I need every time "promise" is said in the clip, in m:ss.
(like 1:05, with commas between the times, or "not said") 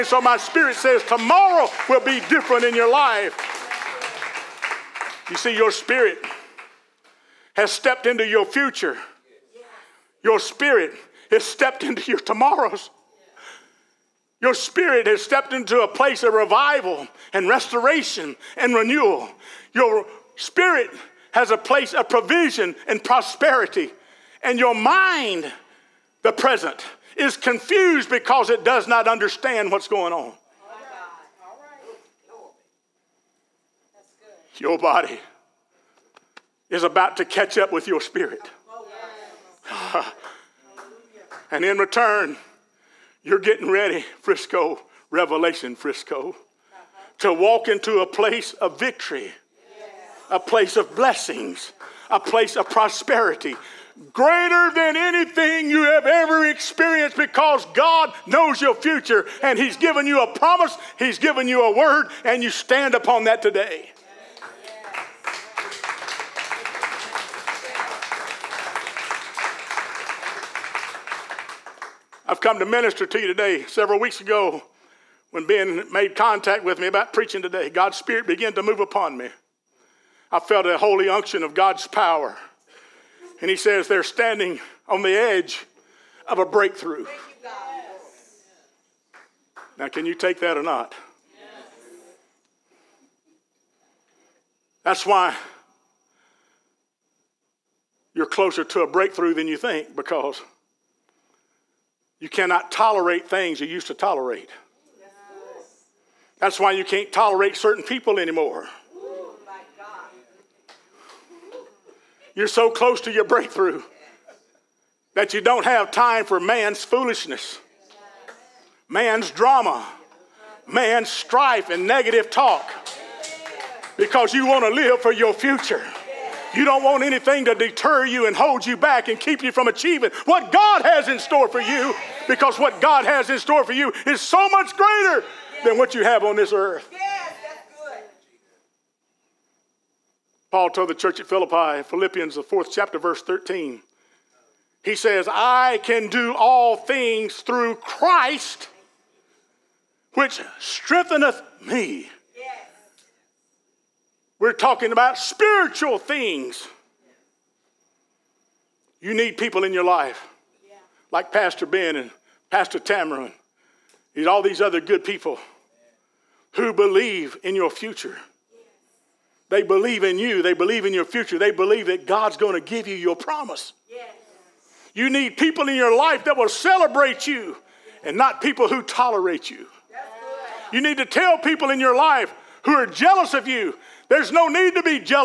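1:00, 2:53.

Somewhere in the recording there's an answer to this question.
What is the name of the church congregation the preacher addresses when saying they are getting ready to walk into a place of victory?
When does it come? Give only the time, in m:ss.
0:45.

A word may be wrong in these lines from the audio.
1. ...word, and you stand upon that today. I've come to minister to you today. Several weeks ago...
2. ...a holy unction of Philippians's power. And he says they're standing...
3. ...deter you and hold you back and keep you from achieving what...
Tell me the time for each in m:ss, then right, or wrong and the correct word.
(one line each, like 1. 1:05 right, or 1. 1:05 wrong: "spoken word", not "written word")
1. 1:01 right
2. 1:20 wrong: "God", not "Philippians"
3. 2:07 right.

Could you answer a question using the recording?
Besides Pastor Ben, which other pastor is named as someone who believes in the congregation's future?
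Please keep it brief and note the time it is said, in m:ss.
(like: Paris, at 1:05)
Pastor Tamara, at 2:42.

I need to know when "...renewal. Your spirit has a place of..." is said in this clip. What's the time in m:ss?
0:18.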